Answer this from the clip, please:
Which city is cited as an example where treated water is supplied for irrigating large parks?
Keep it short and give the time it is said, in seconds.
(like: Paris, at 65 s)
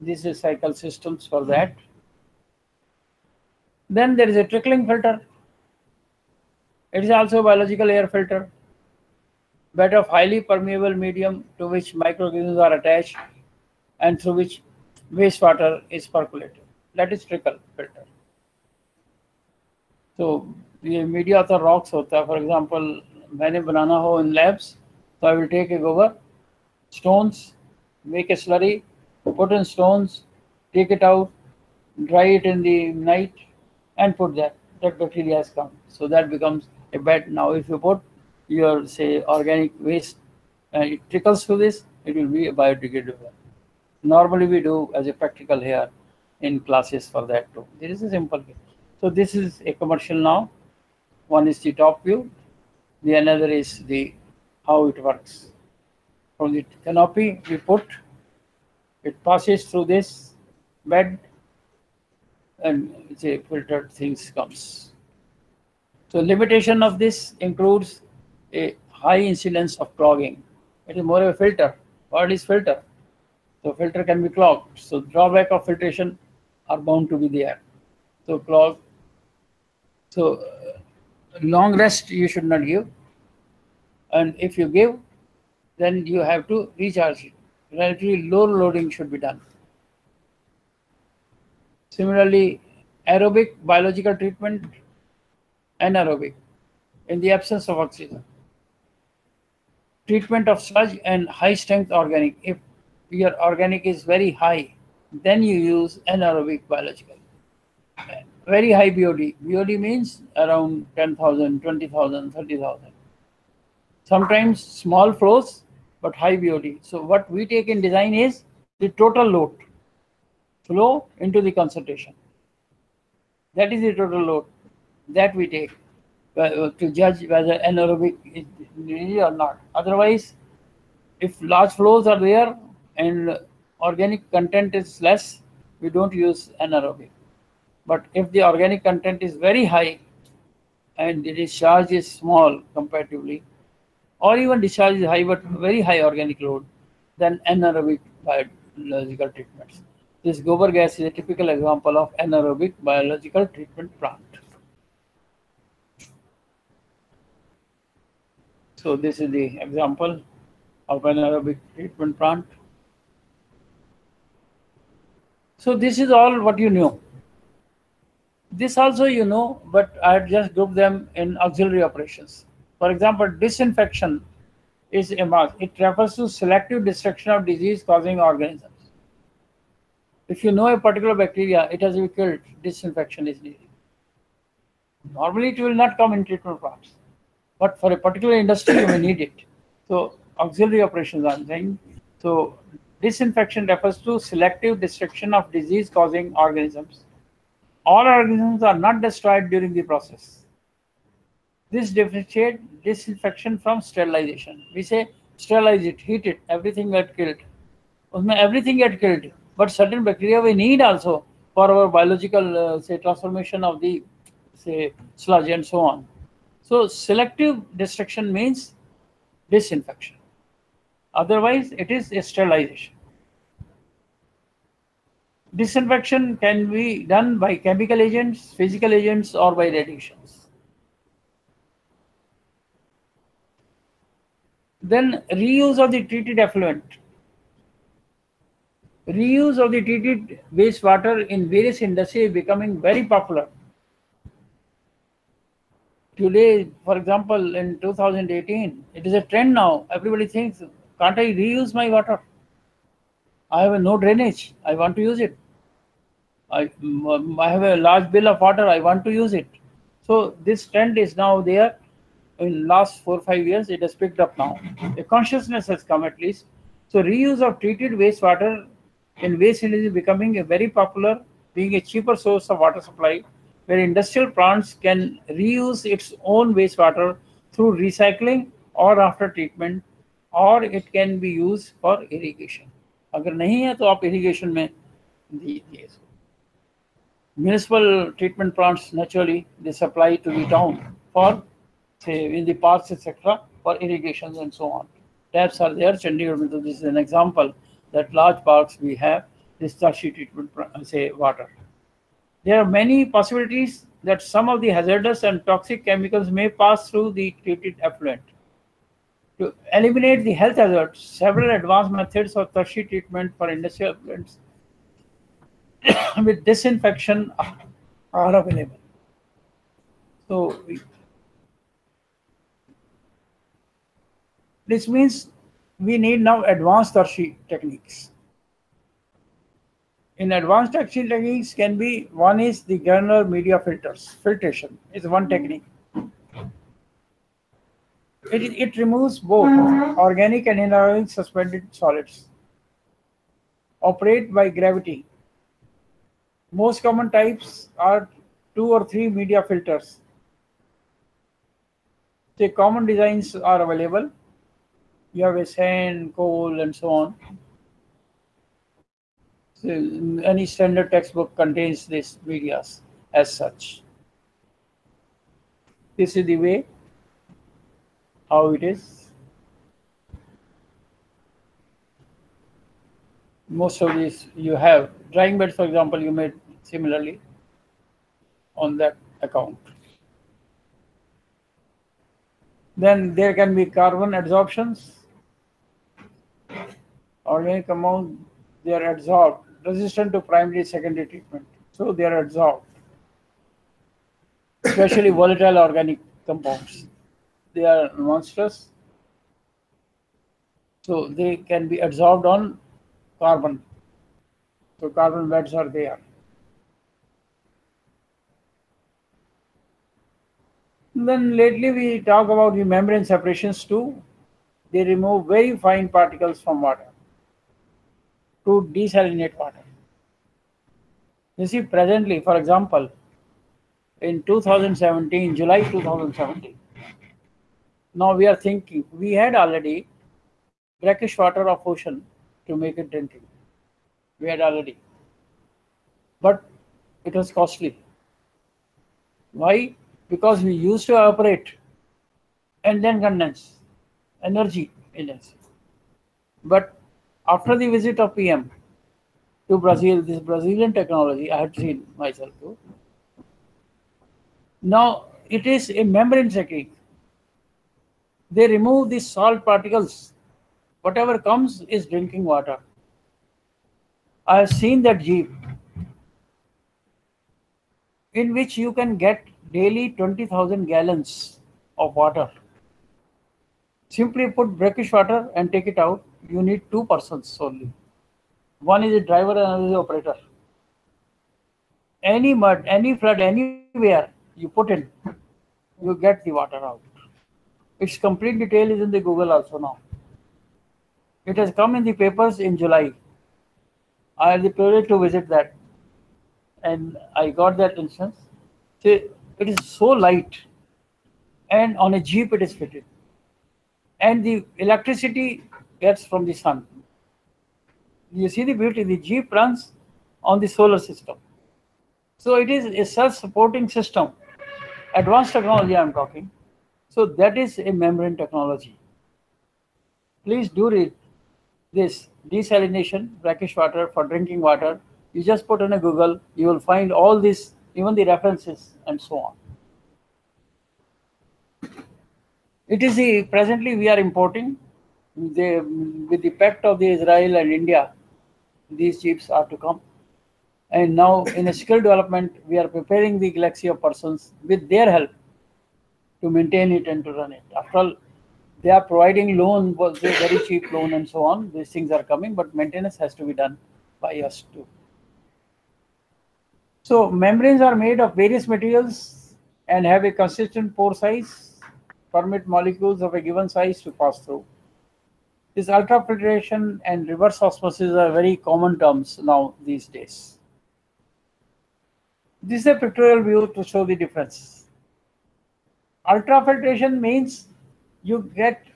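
Chandigarh, at 296 s.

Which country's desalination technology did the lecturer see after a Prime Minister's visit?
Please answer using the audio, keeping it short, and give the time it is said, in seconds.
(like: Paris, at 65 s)
Brazil, at 449 s.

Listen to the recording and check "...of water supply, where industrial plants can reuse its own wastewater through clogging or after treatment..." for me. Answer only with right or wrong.
wrong.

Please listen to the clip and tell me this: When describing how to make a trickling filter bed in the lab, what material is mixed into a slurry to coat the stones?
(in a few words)
Gobar.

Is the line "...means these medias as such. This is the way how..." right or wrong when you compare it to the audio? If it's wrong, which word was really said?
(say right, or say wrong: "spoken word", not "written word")
wrong: "contains", not "means".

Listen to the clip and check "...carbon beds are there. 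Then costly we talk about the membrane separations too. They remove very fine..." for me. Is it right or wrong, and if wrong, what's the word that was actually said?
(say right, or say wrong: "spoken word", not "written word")
wrong: "lately", not "costly".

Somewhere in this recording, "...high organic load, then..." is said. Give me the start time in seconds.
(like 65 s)
145 s.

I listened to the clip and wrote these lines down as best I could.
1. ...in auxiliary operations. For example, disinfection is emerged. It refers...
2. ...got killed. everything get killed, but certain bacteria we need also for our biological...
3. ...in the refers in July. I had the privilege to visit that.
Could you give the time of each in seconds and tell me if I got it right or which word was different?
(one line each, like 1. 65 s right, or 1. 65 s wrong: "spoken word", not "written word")
1. 171 s right
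2. 206 s right
3. 491 s wrong: "papers", not "refers".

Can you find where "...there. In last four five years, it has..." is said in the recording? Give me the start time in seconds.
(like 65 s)
261 s.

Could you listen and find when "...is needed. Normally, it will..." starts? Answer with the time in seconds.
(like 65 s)
183 s.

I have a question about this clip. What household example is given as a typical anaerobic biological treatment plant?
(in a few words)
Gobar gas.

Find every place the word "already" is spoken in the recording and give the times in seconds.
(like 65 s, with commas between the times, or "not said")
429 s, 434 s.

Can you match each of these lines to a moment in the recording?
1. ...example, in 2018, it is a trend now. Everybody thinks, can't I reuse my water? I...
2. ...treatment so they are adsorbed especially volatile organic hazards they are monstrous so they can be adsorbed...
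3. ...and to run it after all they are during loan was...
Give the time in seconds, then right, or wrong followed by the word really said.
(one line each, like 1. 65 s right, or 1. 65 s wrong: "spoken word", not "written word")
1. 246 s right
2. 391 s wrong: "compounds", not "hazards"
3. 546 s wrong: "providing", not "during".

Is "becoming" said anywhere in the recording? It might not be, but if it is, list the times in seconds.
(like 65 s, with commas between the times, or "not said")
242 s, 269 s.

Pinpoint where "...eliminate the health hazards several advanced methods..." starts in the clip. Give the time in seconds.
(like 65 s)
309 s.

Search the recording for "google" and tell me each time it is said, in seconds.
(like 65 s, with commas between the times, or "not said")
489 s, 525 s.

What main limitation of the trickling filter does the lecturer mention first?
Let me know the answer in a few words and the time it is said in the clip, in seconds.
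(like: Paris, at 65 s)
High incidence of clogging, at 68 s.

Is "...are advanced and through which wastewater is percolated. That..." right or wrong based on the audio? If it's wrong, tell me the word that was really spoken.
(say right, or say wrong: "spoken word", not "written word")
wrong: "attached", not "advanced".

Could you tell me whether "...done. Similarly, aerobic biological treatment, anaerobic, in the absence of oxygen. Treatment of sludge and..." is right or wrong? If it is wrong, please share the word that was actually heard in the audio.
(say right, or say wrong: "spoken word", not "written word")
right.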